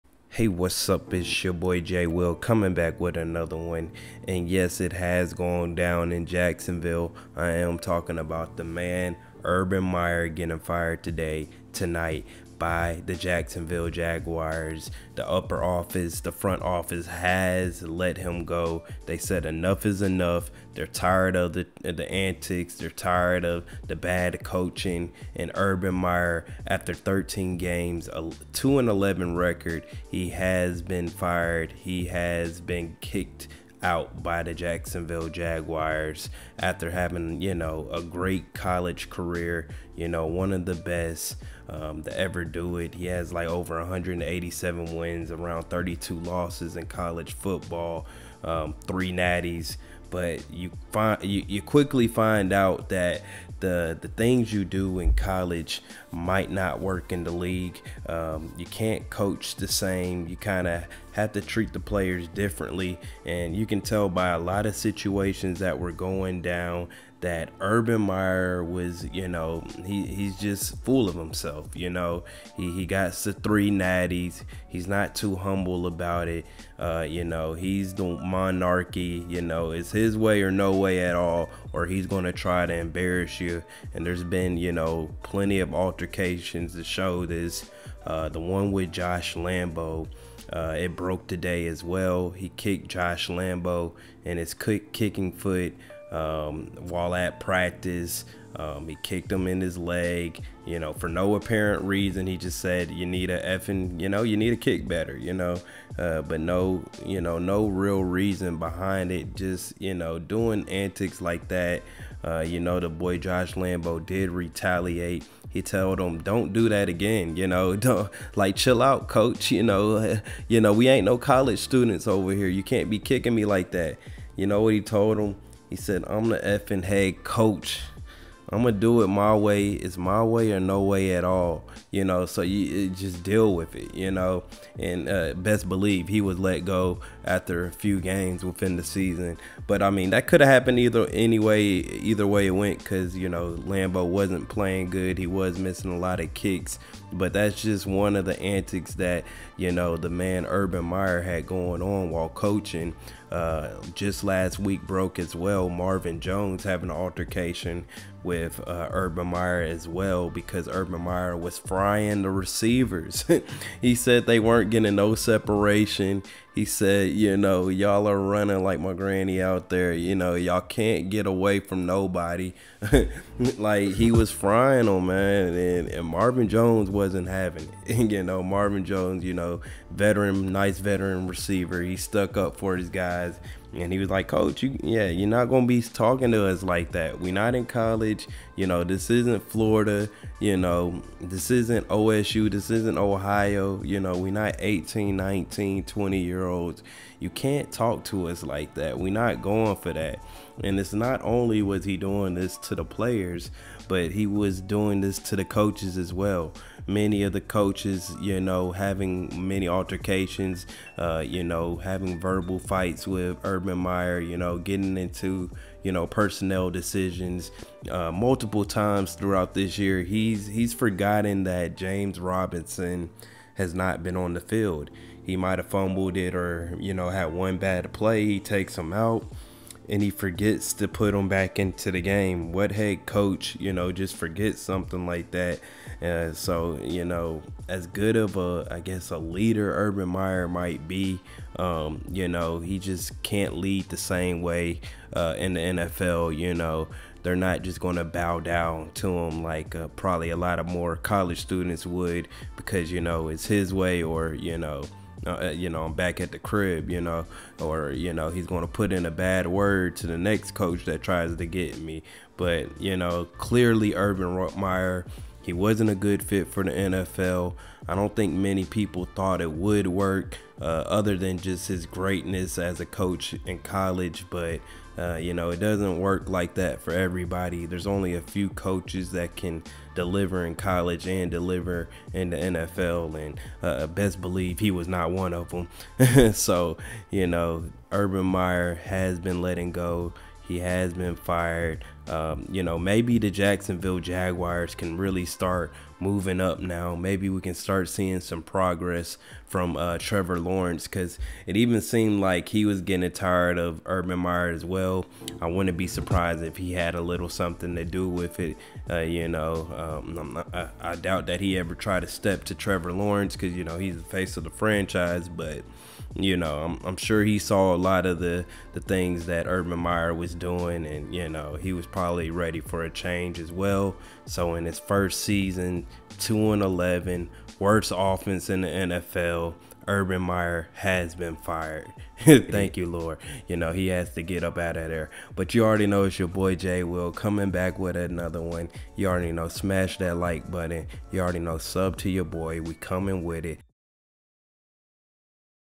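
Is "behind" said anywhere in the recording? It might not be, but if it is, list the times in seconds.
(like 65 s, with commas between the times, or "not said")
108 s.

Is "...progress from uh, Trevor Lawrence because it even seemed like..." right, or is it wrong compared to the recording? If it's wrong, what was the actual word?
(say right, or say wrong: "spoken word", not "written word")
right.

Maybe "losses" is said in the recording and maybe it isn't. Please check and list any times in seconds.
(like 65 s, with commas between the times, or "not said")
46 s.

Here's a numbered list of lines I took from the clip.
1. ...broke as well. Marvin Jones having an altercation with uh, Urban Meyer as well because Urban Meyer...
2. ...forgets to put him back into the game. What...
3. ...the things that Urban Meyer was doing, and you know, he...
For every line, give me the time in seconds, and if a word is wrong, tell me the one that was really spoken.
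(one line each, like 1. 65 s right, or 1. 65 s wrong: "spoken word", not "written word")
1. 154 s right
2. 230 s right
3. 318 s right.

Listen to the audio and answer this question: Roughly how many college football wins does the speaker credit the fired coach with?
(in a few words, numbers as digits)
187.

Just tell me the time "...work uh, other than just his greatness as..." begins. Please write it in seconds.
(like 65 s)
269 s.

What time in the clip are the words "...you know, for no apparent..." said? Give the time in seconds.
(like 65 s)
100 s.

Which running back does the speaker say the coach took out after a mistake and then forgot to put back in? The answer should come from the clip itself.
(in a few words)
James Robinson.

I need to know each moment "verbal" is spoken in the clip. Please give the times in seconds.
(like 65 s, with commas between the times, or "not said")
212 s.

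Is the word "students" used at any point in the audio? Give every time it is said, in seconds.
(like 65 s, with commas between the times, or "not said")
121 s, 251 s.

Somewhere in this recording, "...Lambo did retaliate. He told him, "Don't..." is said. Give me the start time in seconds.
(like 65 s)
113 s.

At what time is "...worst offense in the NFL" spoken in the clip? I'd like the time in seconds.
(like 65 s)
327 s.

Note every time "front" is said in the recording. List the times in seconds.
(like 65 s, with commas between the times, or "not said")
16 s.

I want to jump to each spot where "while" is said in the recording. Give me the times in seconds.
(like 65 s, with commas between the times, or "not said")
96 s, 152 s.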